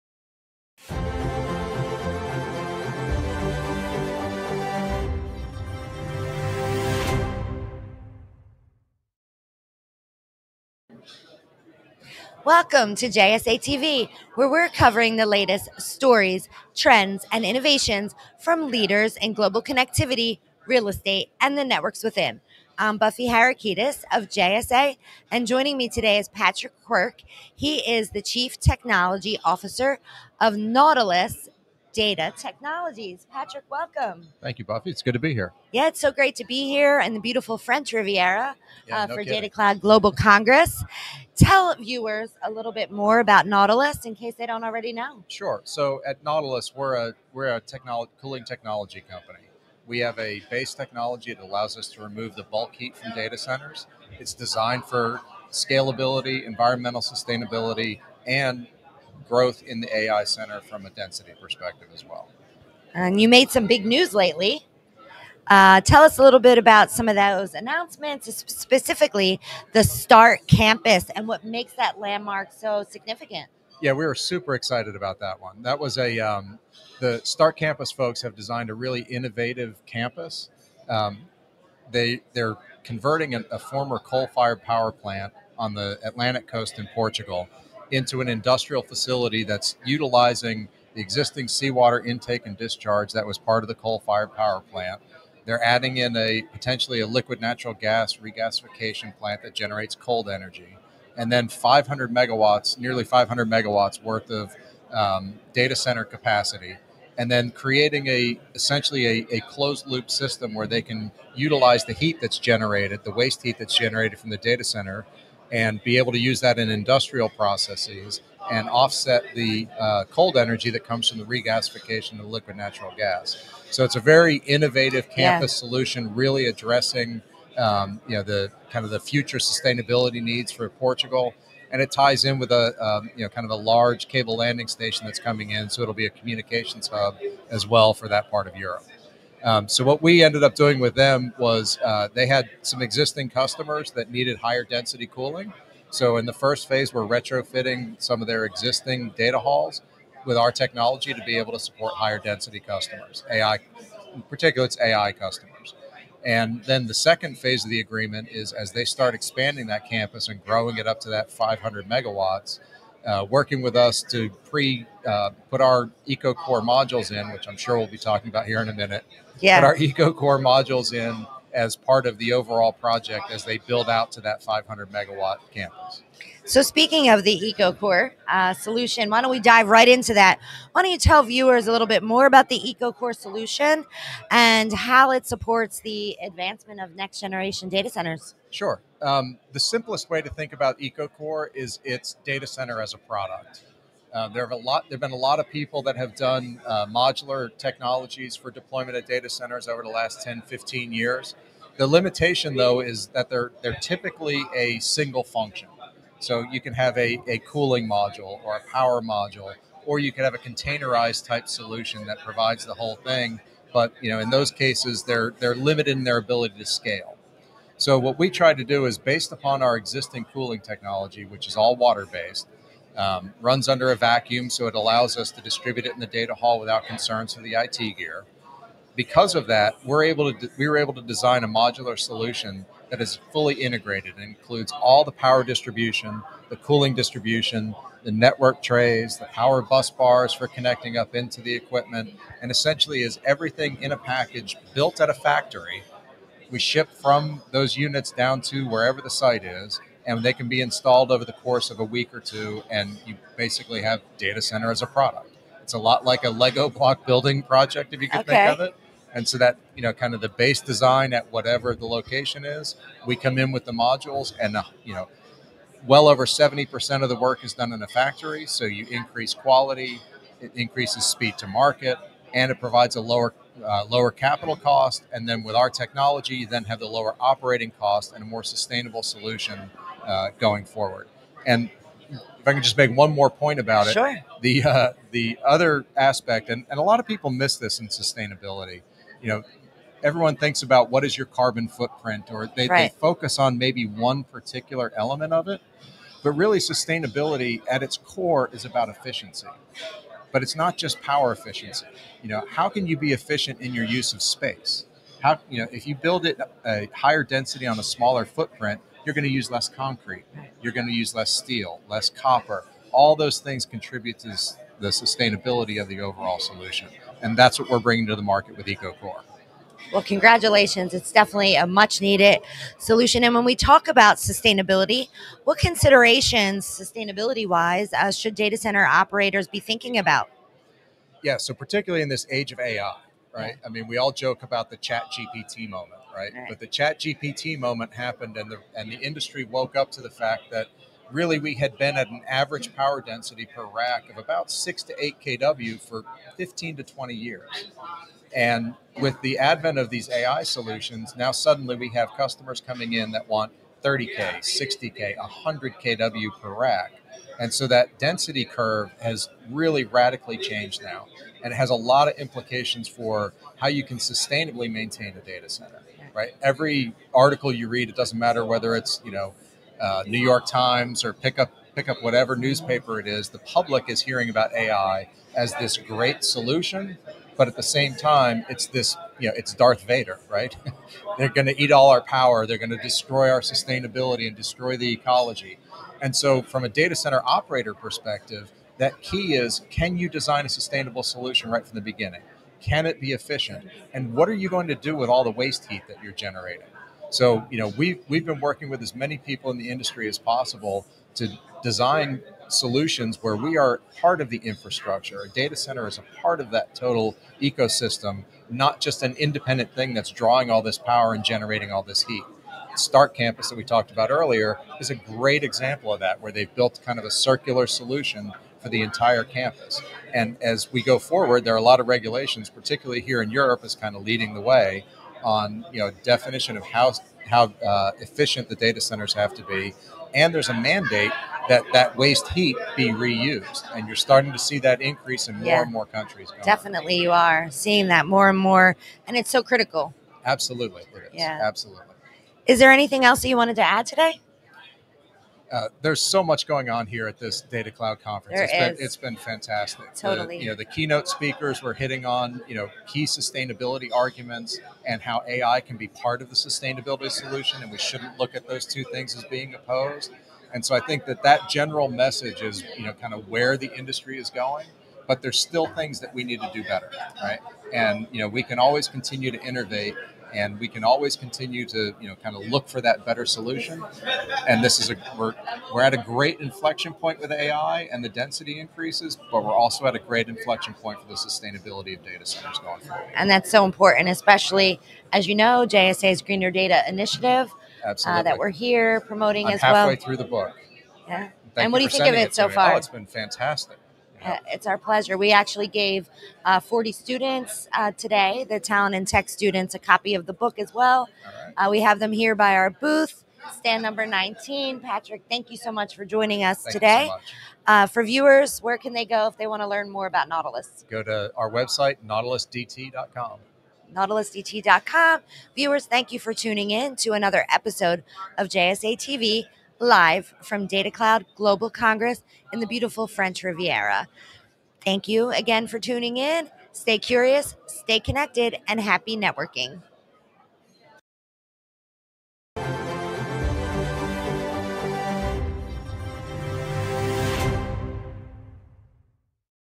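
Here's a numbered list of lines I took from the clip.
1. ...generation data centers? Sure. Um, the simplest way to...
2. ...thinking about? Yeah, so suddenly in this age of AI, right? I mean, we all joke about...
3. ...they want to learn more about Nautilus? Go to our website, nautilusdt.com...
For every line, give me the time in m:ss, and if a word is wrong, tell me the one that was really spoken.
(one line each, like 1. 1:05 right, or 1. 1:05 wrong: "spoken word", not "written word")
1. 3:07 right
2. 5:29 wrong: "particularly", not "suddenly"
3. 8:29 right.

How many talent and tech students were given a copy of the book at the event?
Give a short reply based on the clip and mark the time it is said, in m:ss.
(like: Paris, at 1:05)
40, at 8:16.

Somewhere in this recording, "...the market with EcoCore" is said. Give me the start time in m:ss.
5:18.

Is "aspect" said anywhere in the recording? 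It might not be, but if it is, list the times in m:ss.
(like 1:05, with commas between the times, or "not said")
4:45.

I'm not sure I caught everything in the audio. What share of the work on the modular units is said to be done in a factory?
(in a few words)
over 70%.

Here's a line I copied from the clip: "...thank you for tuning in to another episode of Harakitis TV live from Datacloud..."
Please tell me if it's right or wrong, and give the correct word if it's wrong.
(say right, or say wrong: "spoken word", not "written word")
wrong: "JSA", not "Harakitis".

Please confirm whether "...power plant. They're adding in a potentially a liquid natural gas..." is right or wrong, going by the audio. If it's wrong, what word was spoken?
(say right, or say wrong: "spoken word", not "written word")
right.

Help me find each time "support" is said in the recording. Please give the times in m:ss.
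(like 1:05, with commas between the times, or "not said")
2:31, 3:05.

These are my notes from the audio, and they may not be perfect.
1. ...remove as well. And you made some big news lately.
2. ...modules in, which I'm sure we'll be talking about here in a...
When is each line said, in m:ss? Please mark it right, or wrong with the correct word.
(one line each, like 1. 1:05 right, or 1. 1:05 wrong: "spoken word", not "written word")
1. 1:01 wrong: "perspective", not "remove"
2. 2:46 right.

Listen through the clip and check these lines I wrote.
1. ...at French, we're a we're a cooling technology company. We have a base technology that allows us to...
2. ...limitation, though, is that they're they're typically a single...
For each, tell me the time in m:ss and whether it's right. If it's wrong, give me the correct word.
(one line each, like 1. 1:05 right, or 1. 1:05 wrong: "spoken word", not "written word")
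1. 0:46 wrong: "Nautilus", not "French"
2. 3:21 right.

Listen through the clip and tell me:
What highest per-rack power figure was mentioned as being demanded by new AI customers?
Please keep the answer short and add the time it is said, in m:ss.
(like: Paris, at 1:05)
100 kW, at 5:55.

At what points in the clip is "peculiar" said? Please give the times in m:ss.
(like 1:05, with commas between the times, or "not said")
not said.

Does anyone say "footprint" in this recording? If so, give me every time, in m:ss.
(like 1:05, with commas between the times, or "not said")
4:51, 5:08.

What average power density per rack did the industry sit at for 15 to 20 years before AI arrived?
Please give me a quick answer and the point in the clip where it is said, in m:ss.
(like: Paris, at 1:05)
6 to 8 kW, at 5:44.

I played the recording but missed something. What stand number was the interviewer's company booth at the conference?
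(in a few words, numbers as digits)
19.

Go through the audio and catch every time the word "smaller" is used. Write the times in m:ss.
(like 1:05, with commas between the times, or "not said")
5:07.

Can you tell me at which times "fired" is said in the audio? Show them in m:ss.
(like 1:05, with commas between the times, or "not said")
1:24, 1:33.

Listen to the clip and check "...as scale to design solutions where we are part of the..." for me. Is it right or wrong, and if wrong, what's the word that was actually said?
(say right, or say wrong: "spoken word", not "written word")
wrong: "possible", not "scale".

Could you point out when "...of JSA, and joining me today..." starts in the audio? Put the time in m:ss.
0:24.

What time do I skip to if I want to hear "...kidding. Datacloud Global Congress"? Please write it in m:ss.
0:39.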